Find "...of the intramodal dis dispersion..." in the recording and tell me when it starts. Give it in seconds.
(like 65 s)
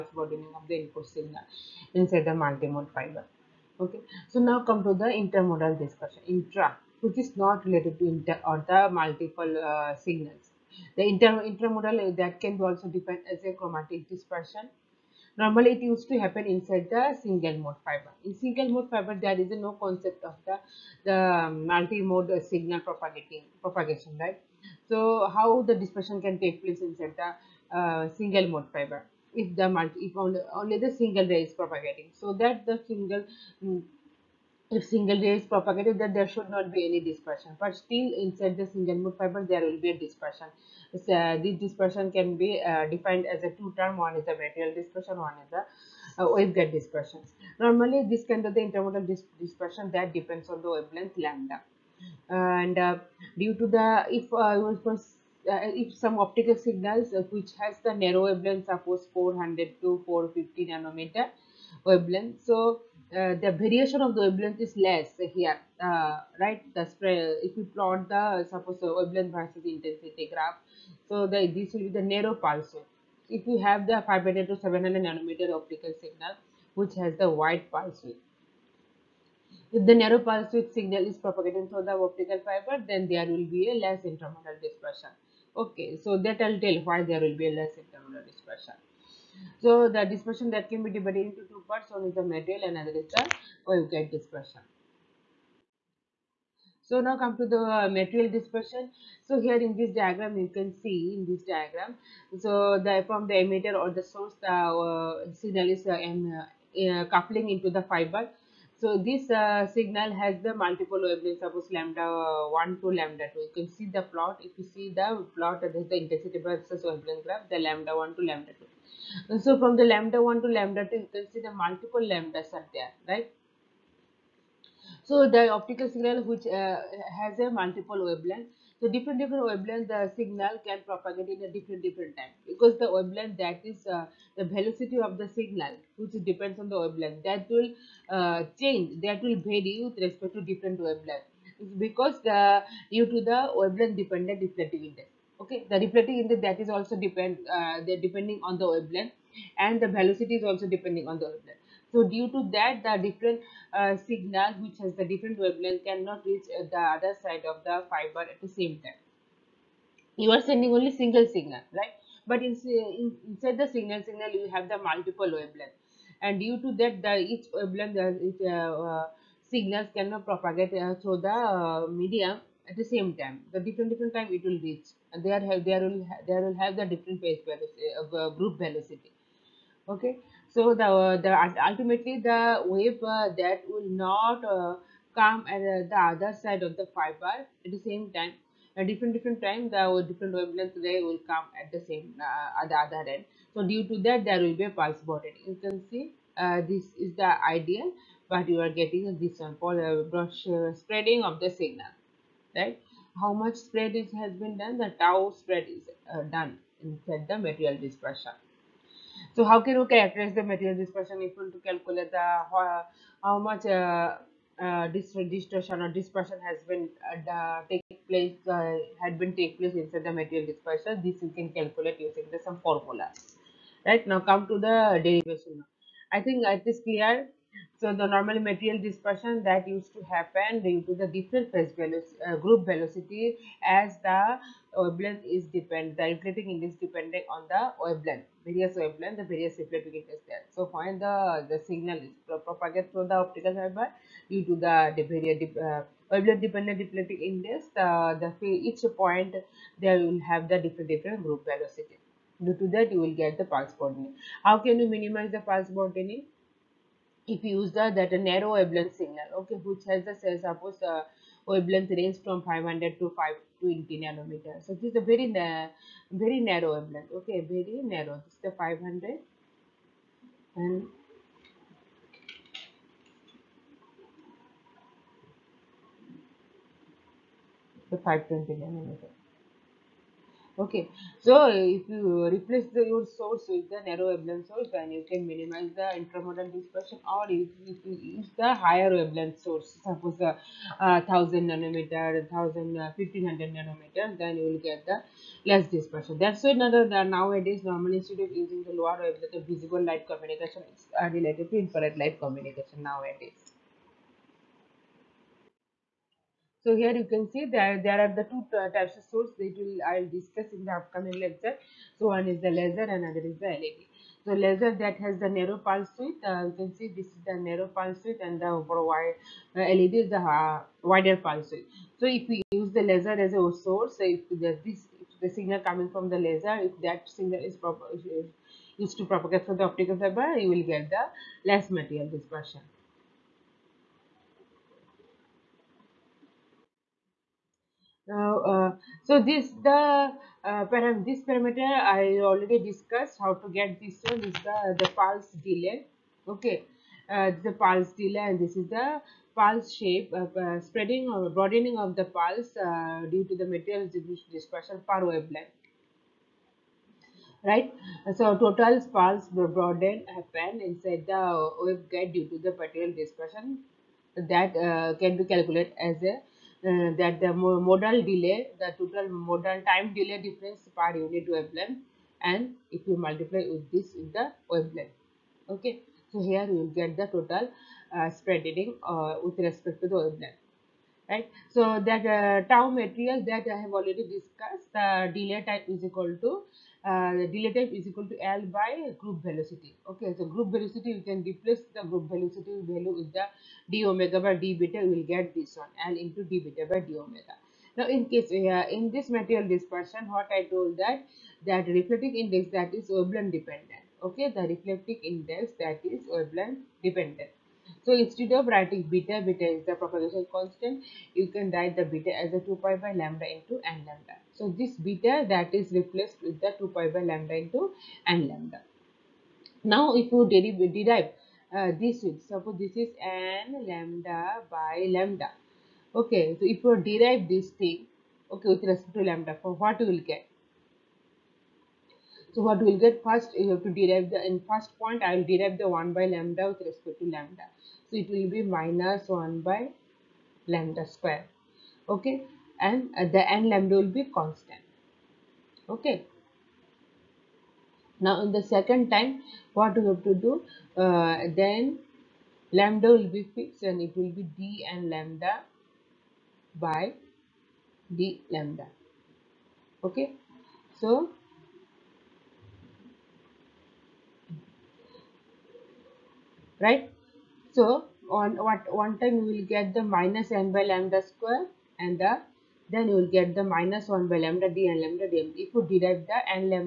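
48 s.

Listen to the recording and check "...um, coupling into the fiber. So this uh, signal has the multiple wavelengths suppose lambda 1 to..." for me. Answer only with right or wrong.
right.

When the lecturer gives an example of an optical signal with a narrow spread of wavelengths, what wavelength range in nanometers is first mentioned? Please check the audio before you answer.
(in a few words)
400 to 450.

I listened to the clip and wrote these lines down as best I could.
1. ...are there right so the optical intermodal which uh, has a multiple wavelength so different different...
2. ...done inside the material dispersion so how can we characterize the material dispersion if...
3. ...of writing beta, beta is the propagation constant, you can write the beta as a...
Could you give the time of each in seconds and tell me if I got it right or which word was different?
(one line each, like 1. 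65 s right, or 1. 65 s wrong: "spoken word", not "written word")
1. 122 s wrong: "signal", not "intermodal"
2. 206 s right
3. 408 s right.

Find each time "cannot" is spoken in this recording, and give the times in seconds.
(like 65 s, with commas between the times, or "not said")
155 s, 169 s.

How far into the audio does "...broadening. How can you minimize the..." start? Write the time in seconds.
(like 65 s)
253 s.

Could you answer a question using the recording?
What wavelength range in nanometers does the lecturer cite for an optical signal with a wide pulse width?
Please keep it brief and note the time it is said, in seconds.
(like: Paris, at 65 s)
500 to 700, at 74 s.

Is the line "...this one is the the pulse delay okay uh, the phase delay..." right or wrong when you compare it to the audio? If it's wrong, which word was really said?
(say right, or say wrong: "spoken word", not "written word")
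wrong: "pulse", not "phase".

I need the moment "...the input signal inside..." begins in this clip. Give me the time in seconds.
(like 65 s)
0 s.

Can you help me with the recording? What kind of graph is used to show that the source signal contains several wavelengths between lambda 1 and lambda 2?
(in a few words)
intensity versus wavelength.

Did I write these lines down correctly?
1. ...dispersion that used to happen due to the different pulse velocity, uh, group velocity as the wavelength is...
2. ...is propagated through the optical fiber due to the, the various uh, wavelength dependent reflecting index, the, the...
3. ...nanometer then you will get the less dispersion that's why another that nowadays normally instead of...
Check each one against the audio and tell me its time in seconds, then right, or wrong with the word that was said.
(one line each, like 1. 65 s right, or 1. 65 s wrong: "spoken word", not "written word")
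1. 228 s wrong: "phase", not "pulse"
2. 241 s right
3. 293 s right.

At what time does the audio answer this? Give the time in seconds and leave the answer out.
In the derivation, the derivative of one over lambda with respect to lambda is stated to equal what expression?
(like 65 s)
438 s.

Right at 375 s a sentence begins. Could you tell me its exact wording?
Okay, so here you will get the total uh, spread uh, with respect to the wavelength.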